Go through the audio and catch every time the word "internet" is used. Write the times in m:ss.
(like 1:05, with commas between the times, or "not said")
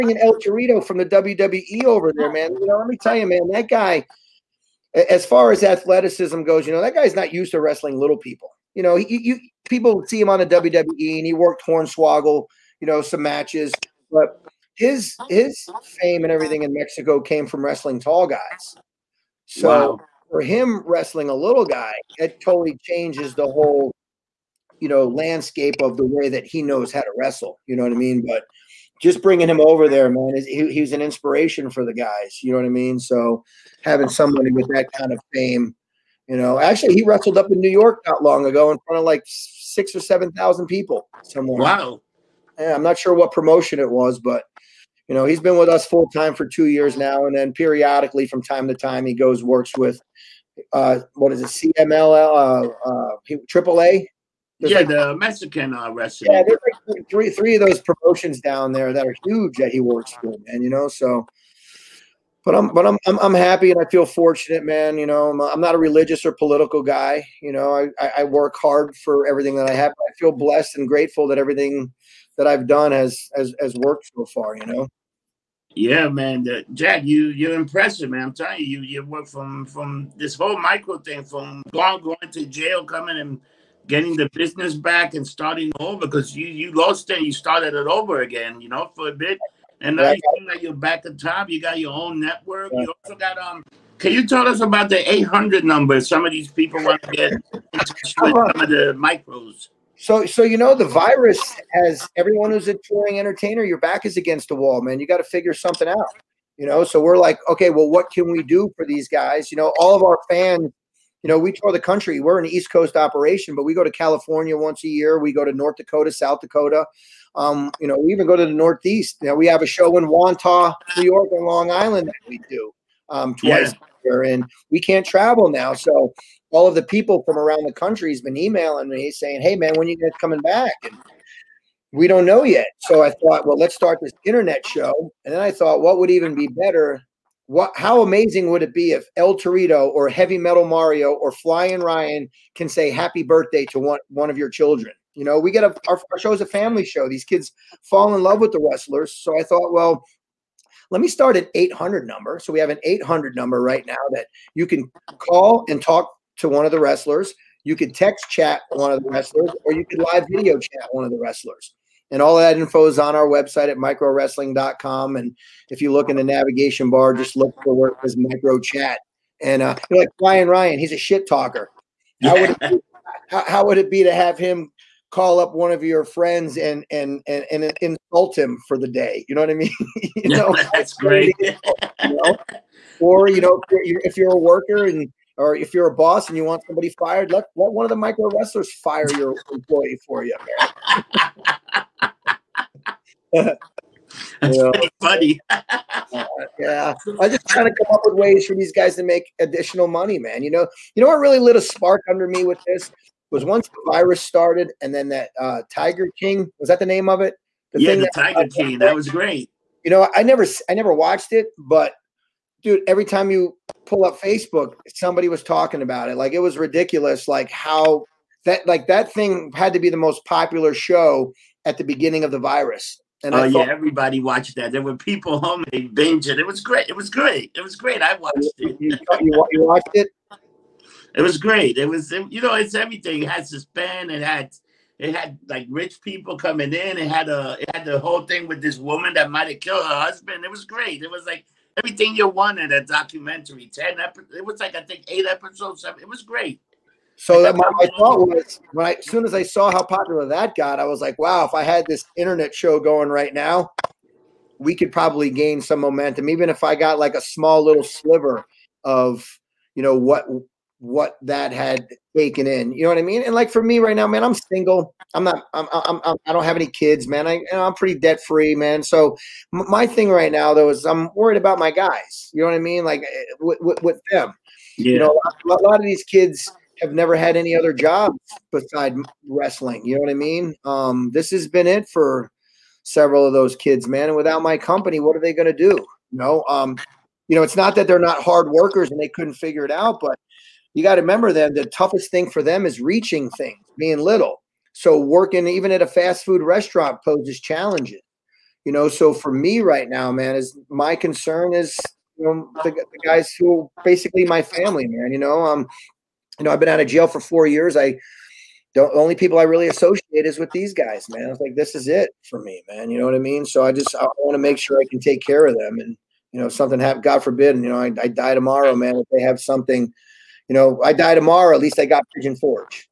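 2:14, 4:12.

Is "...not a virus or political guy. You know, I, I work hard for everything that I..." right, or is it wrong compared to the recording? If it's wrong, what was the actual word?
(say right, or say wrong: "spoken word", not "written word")
wrong: "religious", not "virus".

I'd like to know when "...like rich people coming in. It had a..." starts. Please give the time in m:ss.
3:55.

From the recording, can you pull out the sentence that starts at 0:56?
Yeah, there's like three three of those promotions down there that are huge that he works for, and you know, so.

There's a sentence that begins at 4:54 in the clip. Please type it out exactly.
So working even at a fast food restaurant poses challenges.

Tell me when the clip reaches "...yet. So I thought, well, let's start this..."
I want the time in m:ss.
2:12.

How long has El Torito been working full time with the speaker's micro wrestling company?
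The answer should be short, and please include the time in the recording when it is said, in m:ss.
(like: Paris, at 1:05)
2 years, at 0:46.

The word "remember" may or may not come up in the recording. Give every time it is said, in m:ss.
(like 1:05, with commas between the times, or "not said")
4:51.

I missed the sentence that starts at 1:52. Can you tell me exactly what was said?
We're an East Coast operation, but we go to California once a year.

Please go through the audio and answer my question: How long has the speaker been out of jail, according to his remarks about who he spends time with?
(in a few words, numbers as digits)
4 years.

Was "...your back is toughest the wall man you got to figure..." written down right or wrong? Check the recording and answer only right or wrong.
wrong.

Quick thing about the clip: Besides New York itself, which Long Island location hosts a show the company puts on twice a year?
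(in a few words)
Wantagh.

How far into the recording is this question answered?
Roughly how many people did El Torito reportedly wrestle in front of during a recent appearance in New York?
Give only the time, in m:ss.
0:39.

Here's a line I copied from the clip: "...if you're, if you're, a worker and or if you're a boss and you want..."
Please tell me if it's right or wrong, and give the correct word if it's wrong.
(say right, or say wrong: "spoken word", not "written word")
right.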